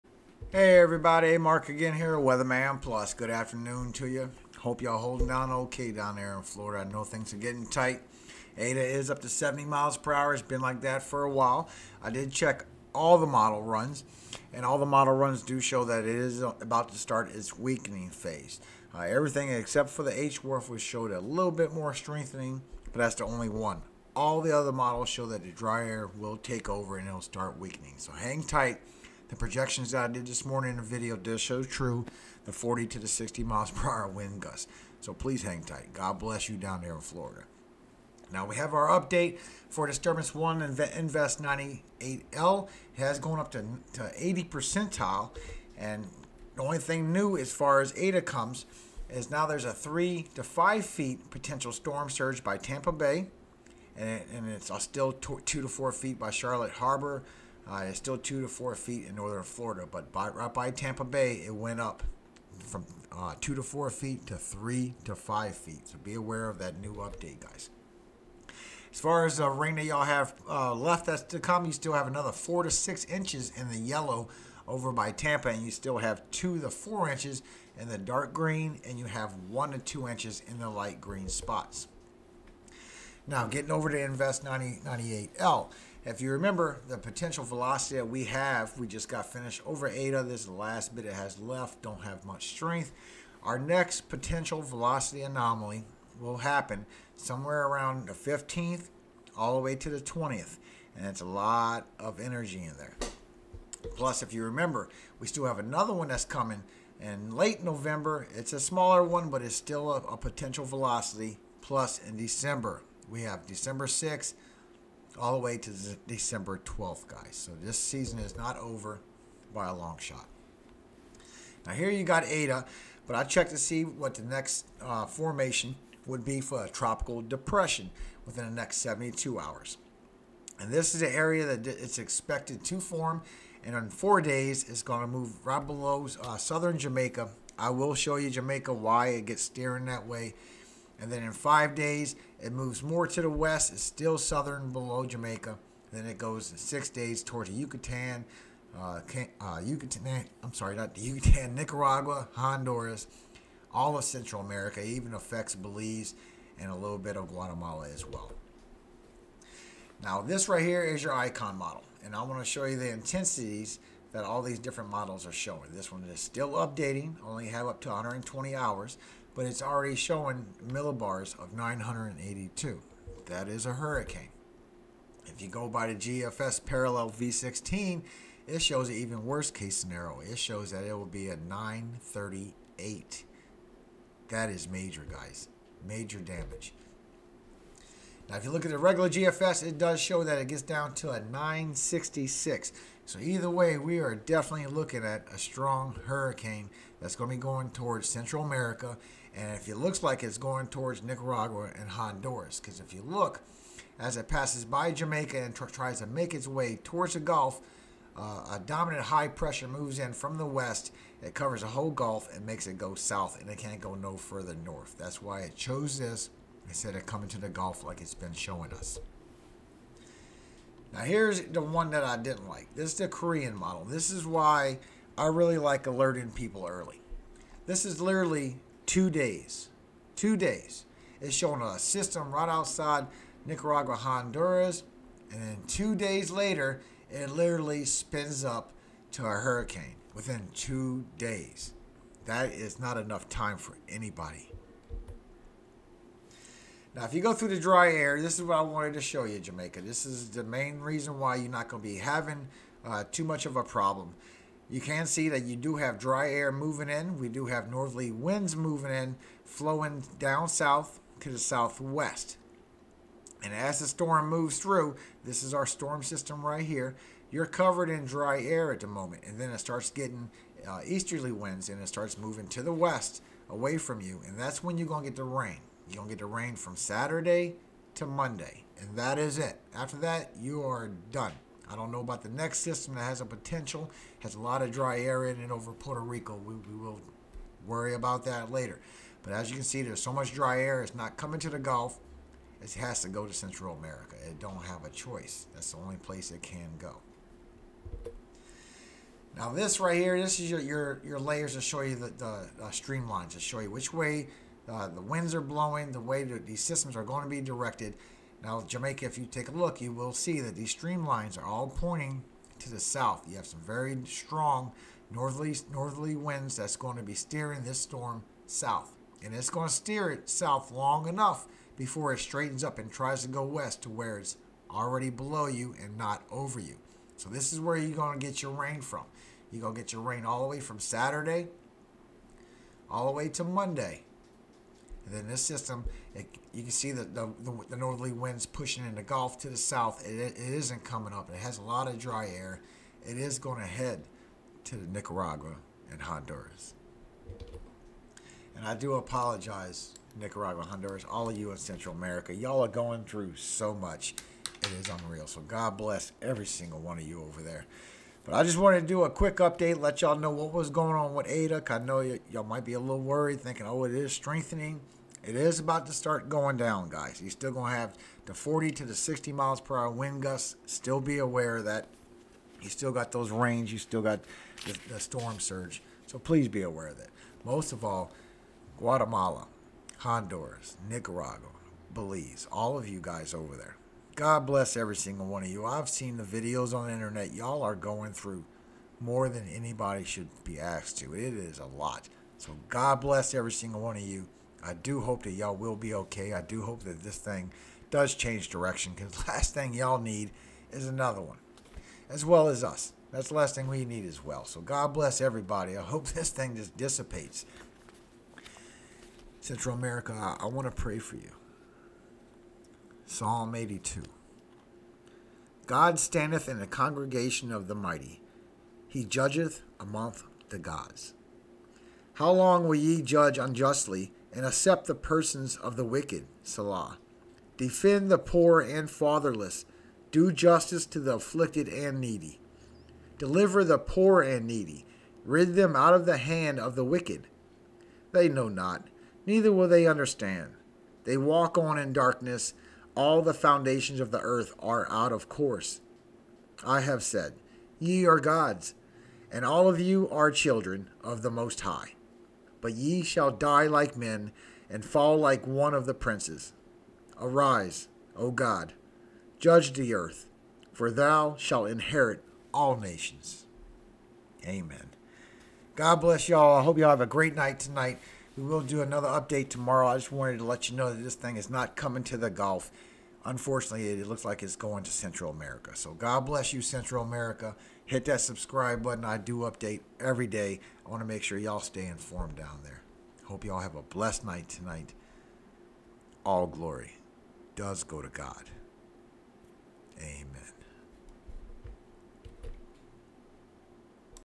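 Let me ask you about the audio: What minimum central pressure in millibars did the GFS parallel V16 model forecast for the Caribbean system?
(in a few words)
938.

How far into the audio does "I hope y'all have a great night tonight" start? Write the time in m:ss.
7:46.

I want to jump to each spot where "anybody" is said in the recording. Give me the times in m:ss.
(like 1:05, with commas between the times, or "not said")
4:03, 6:29.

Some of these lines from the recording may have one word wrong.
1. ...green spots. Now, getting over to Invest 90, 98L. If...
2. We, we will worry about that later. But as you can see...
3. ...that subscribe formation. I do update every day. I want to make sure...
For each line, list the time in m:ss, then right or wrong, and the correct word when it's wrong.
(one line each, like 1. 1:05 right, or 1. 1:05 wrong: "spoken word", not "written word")
1. 1:20 right
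2. 4:46 right
3. 7:58 wrong: "button", not "formation".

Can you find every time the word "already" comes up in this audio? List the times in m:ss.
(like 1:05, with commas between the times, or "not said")
2:49, 5:24.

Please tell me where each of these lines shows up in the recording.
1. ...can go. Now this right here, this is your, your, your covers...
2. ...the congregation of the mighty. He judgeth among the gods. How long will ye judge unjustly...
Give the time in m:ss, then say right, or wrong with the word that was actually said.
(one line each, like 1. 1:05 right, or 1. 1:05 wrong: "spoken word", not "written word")
1. 4:56 wrong: "layers", not "covers"
2. 6:56 right.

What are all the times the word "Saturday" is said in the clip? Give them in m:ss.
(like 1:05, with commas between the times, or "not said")
4:36, 5:30.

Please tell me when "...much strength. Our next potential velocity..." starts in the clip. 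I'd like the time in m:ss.
1:32.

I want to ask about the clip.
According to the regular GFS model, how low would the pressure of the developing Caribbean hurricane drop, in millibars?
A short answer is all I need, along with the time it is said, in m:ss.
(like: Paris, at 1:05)
966, at 3:11.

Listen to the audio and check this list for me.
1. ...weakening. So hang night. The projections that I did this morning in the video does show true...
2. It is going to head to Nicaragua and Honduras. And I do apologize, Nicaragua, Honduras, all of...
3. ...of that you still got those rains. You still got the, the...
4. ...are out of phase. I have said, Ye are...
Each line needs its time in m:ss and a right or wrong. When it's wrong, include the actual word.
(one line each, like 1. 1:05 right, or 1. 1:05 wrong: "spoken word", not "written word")
1. 0:27 wrong: "tight", not "night"
2. 5:43 right
3. 6:11 right
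4. 7:24 wrong: "course", not "phase".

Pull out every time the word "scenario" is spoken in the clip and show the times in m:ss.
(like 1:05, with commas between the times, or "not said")
2:59.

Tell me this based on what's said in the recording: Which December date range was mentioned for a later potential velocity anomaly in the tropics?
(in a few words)
December 6 to 12.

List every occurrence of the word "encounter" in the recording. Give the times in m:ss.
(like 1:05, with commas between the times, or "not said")
not said.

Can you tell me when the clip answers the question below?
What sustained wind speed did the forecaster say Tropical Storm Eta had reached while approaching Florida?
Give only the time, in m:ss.
0:09.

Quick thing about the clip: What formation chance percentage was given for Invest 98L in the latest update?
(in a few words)
80.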